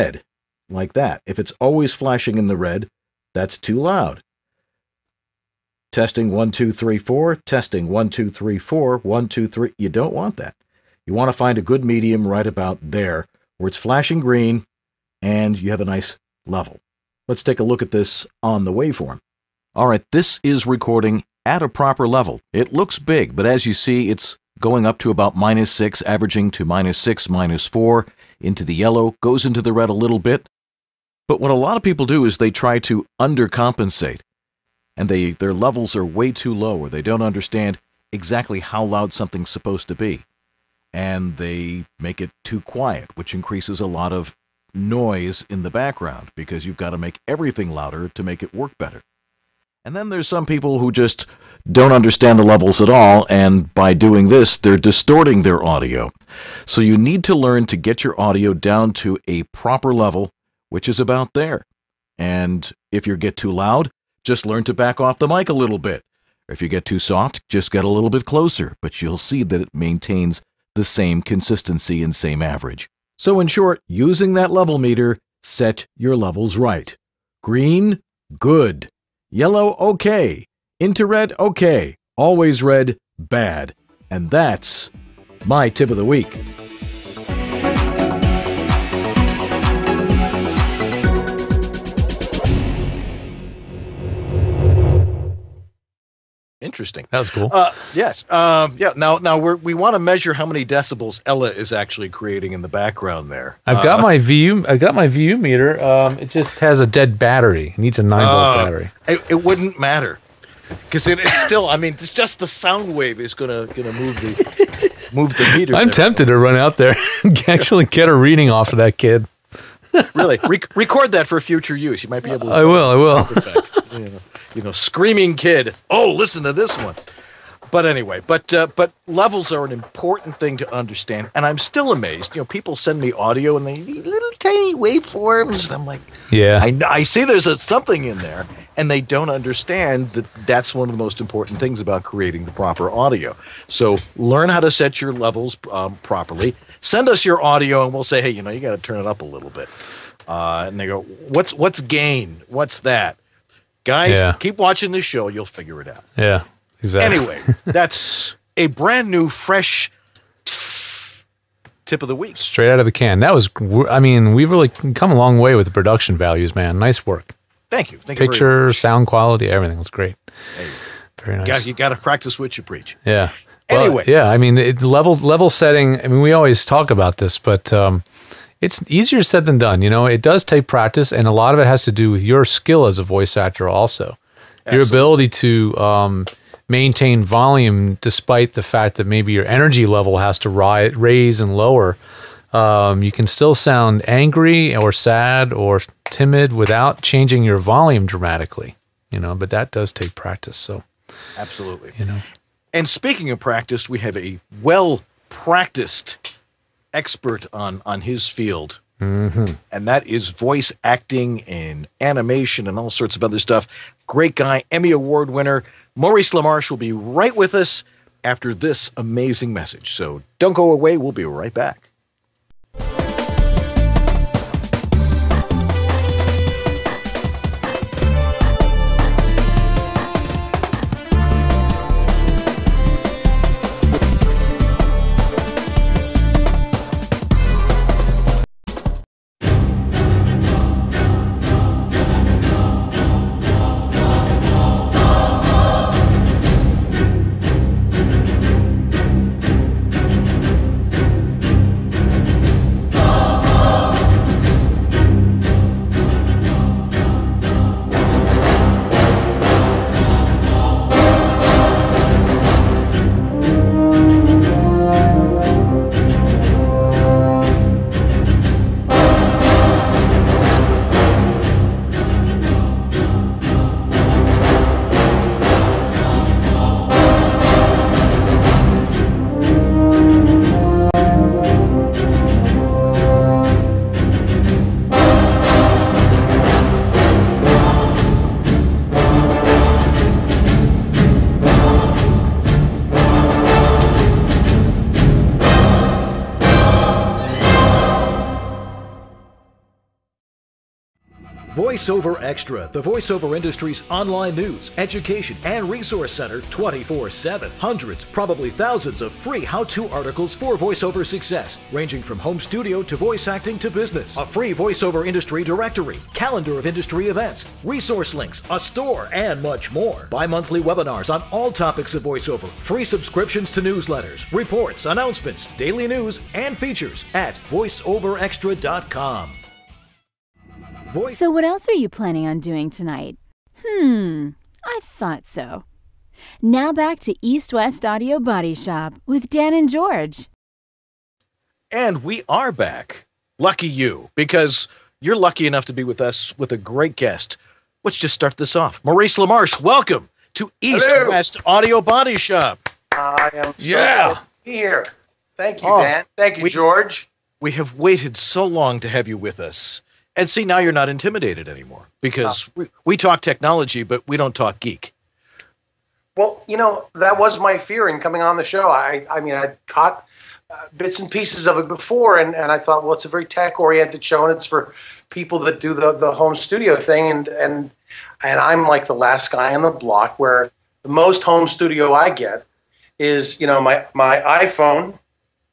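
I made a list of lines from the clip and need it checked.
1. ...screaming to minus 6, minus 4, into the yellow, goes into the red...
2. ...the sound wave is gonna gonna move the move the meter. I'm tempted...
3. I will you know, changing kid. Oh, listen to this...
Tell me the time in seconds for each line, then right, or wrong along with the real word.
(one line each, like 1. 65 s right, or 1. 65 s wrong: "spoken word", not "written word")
1. 26 s wrong: "averaging", not "screaming"
2. 112 s right
3. 122 s wrong: "screaming", not "changing".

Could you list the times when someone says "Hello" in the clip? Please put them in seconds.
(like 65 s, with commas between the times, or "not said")
350 s.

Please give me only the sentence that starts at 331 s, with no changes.
So, what else are you planning on doing tonight?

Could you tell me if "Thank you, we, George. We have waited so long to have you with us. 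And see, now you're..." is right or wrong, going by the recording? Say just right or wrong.
right.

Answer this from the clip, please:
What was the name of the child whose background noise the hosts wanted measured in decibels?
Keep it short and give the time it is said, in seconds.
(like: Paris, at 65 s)
Ella, at 101 s.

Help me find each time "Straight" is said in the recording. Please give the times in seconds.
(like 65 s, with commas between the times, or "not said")
162 s.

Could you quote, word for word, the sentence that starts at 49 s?
And then there's some people who just don't understand the levels at all, and by doing this, they're distorting their audio.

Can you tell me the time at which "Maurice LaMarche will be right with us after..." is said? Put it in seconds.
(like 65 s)
215 s.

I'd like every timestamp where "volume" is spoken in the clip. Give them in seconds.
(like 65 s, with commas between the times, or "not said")
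187 s, 197 s.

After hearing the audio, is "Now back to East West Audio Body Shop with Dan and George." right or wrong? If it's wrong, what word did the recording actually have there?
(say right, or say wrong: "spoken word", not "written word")
right.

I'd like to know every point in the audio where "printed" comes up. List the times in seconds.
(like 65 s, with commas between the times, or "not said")
not said.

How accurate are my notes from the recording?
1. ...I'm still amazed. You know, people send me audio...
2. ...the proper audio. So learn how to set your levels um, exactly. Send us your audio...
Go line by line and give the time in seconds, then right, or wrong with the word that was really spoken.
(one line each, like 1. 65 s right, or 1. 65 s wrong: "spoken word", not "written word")
1. 131 s right
2. 142 s wrong: "properly", not "exactly".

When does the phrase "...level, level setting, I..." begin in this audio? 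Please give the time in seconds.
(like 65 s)
174 s.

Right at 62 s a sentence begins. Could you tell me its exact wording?
And if you get too loud, just learn to back off the mic a little bit.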